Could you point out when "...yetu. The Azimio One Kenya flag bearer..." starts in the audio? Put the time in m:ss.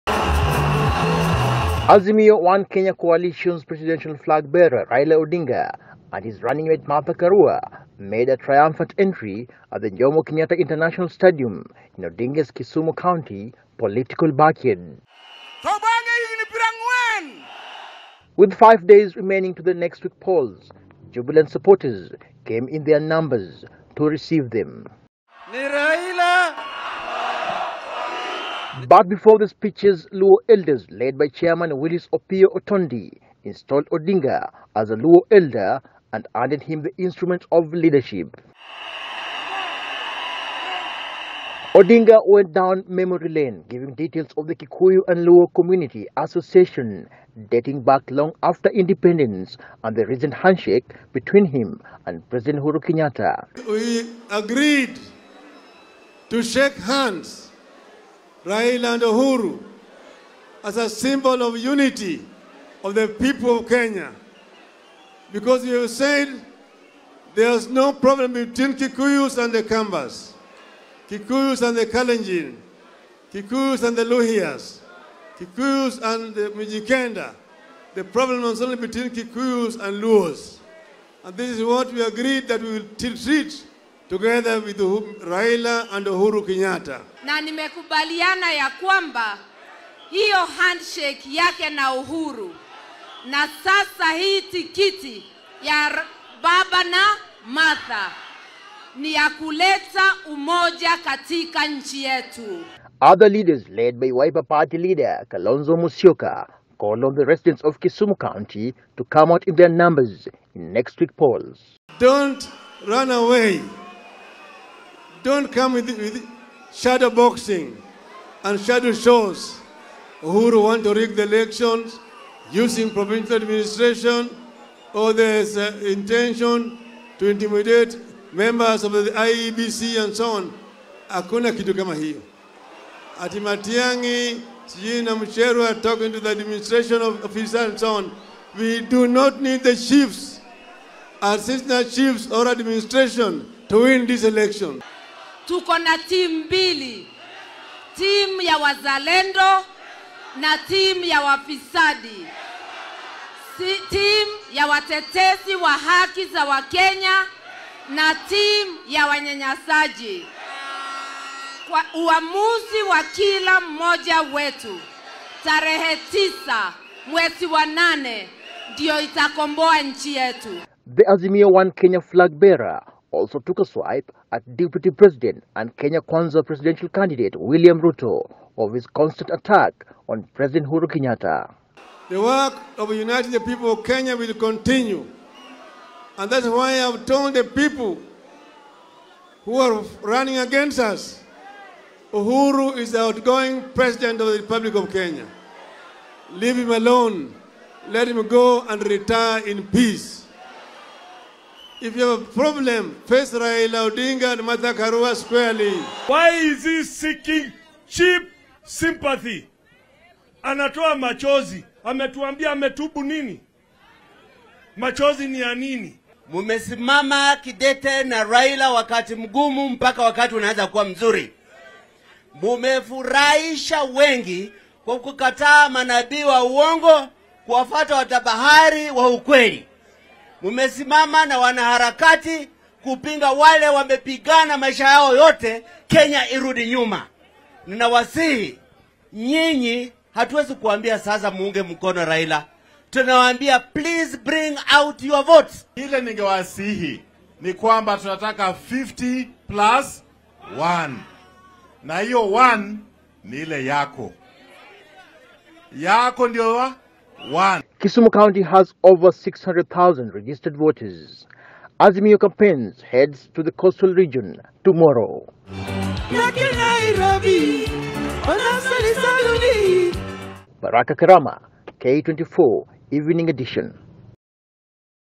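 2:50.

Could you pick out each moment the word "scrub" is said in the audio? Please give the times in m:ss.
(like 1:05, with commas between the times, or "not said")
not said.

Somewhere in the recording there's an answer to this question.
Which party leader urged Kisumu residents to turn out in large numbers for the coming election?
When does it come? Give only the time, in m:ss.
1:45.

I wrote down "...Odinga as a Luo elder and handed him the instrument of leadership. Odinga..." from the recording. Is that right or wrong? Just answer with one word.
right.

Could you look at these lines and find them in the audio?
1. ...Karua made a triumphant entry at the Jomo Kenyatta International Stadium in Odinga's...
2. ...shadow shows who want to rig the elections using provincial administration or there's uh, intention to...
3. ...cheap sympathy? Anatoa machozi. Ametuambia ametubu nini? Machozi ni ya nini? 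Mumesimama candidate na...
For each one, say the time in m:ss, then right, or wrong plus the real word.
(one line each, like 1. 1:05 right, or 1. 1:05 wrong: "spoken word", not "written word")
1. 0:07 right
2. 1:58 right
3. 3:27 wrong: "kidete", not "candidate".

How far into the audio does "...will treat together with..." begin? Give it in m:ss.
1:22.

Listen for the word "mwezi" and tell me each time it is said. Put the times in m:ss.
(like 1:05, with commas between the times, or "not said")
2:47.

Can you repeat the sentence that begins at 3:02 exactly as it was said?
The work of uniting the people of Kenya will continue.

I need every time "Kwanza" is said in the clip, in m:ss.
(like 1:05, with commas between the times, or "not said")
2:56.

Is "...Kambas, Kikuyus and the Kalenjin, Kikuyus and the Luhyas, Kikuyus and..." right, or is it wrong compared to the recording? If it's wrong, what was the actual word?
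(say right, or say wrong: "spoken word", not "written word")
right.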